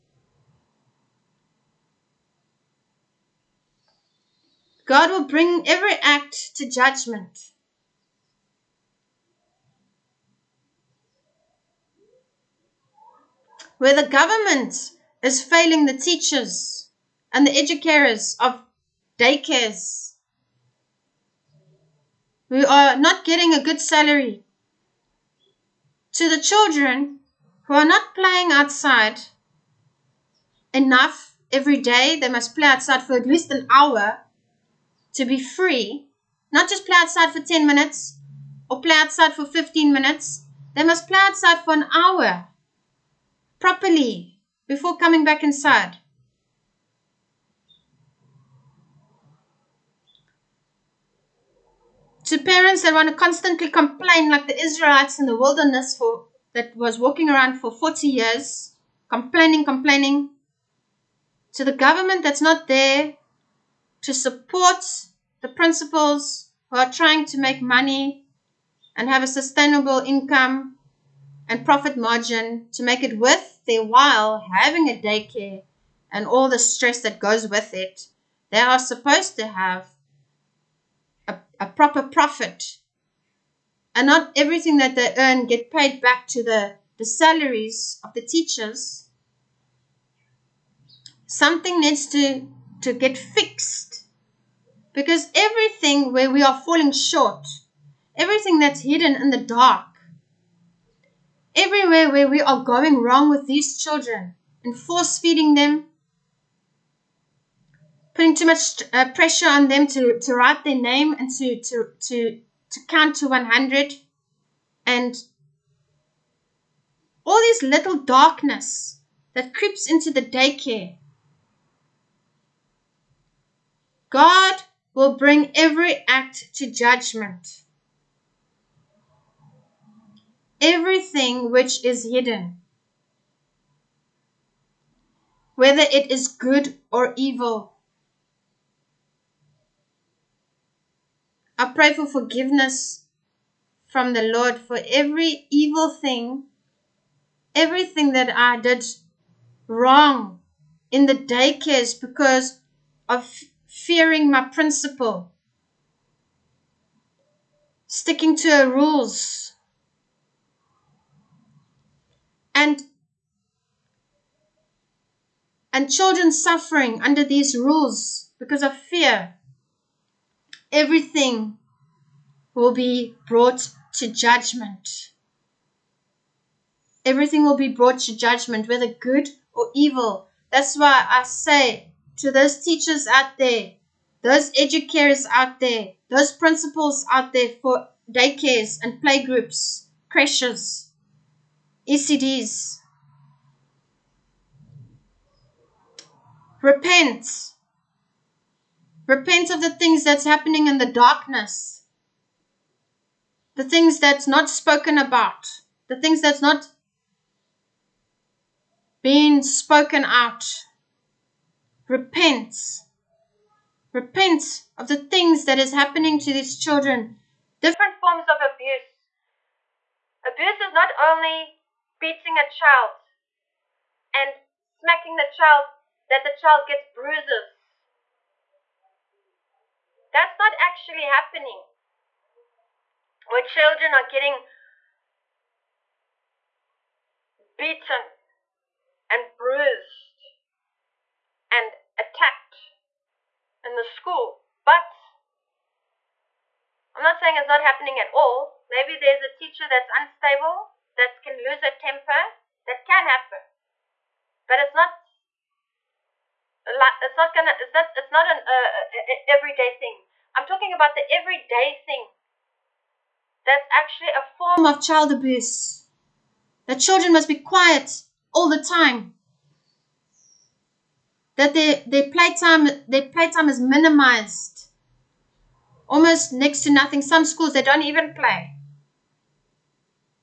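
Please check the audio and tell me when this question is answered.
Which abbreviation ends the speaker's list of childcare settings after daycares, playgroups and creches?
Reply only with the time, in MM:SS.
03:11.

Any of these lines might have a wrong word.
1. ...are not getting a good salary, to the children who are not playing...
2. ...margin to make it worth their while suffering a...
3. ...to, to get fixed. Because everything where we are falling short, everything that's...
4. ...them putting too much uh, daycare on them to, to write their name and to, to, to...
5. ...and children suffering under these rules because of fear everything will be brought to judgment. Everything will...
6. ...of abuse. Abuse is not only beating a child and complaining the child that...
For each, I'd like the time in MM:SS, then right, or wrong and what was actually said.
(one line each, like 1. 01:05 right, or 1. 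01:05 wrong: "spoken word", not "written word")
1. 00:22 right
2. 01:11 wrong: "having", not "suffering"
3. 01:32 right
4. 01:45 wrong: "pressure", not "daycare"
5. 02:45 right
6. 03:38 wrong: "smacking", not "complaining".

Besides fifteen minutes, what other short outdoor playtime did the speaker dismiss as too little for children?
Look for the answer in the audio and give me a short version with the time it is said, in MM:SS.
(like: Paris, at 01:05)
10 minutes, at 00:37.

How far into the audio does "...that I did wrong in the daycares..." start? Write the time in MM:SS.
02:28.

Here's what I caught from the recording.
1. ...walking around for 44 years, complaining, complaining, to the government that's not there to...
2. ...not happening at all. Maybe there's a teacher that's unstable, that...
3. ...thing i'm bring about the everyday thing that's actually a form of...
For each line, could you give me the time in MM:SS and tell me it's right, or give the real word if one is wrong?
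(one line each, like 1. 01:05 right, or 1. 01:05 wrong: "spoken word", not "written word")
1. 00:56 wrong: "40", not "44"
2. 04:07 right
3. 04:19 wrong: "talking", not "bring".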